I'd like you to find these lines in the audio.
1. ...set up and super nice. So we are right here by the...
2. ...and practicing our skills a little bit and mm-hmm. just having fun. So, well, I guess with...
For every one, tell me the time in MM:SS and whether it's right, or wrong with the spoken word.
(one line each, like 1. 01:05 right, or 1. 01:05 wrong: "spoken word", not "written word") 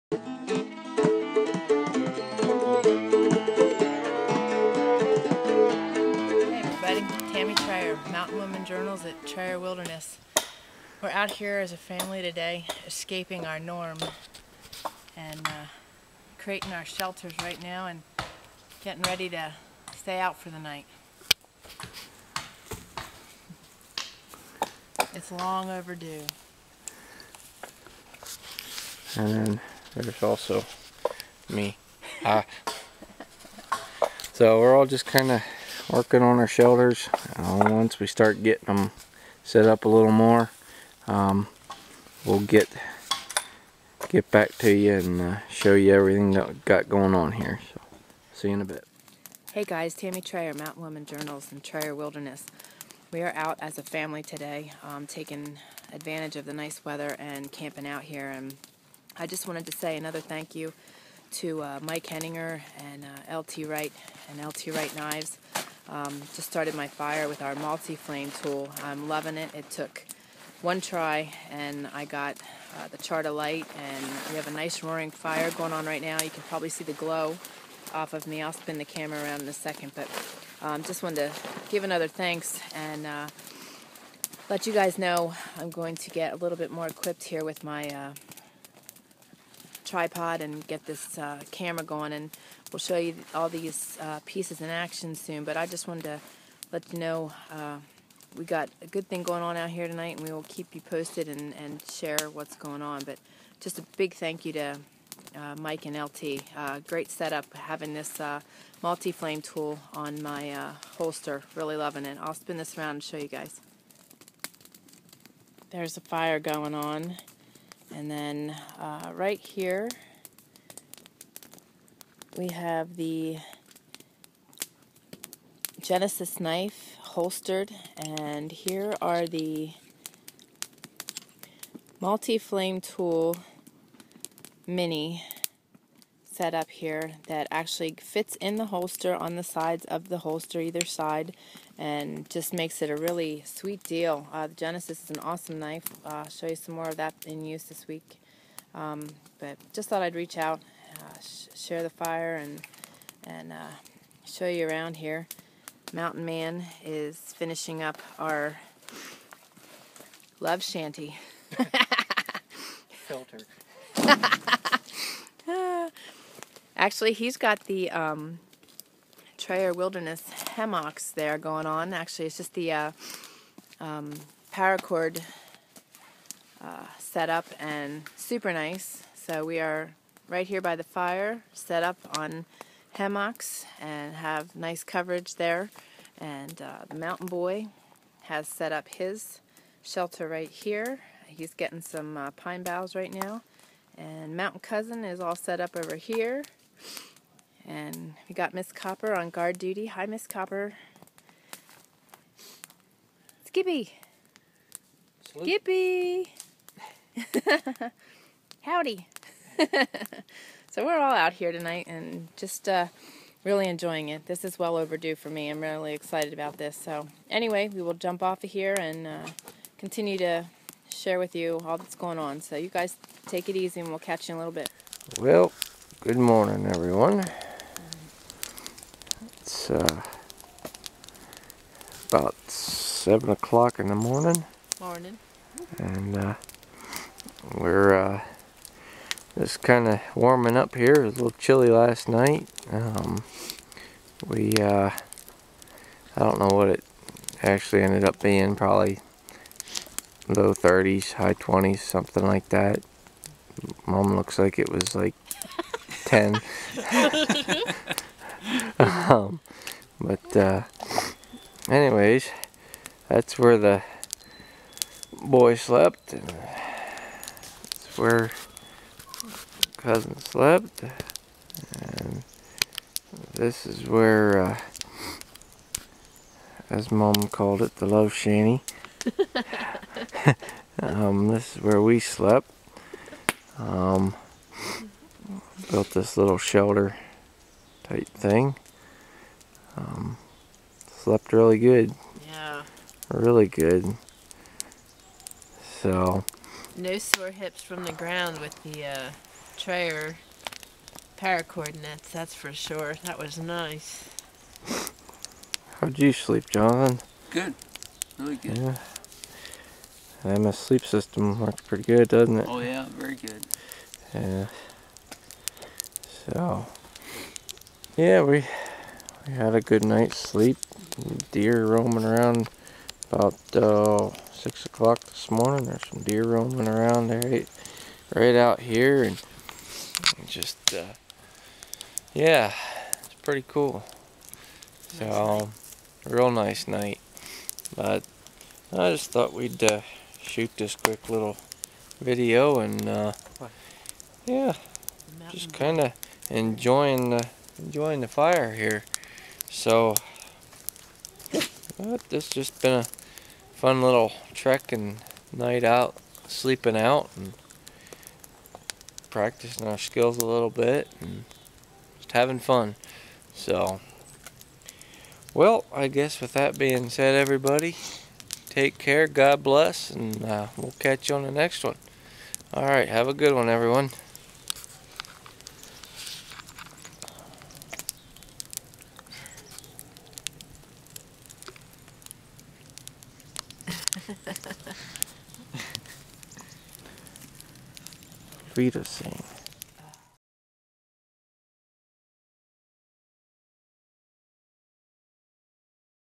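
1. 02:56 right
2. 05:57 right.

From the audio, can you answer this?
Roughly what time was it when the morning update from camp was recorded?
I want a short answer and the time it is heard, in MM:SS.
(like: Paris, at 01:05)
7 o'clock, at 03:52.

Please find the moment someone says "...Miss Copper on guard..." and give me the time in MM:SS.
03:18.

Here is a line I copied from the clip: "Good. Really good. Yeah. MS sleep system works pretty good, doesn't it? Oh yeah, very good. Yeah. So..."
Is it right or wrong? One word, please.
right.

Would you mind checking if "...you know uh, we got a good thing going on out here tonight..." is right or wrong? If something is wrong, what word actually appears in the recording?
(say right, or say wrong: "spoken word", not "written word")
right.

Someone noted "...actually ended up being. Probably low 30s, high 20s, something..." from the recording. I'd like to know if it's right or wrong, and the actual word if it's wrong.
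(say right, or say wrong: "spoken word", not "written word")
right.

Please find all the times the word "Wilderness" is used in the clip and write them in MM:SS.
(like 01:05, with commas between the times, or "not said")
00:51, 02:49.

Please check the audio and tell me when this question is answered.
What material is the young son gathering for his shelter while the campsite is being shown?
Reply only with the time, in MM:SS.
03:12.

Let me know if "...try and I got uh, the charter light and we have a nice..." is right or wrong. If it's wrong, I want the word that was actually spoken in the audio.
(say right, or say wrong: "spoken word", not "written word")
right.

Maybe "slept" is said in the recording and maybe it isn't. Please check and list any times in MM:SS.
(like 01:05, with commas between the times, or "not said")
04:25, 04:30, 04:41, 04:50.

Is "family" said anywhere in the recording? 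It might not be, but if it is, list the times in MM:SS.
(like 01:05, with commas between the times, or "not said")
00:11, 00:53.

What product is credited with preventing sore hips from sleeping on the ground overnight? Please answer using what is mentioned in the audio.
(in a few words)
Trayer power nets.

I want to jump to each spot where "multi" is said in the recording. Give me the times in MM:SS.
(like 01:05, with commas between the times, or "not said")
01:07, 01:48, 02:11.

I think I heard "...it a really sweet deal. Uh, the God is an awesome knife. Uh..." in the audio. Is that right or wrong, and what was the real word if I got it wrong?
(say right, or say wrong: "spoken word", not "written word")
wrong: "Genesis", not "God".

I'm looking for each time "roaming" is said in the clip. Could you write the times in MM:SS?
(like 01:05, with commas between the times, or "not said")
05:21, 05:26.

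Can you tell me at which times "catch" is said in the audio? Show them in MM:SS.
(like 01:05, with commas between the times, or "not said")
03:43, 06:10.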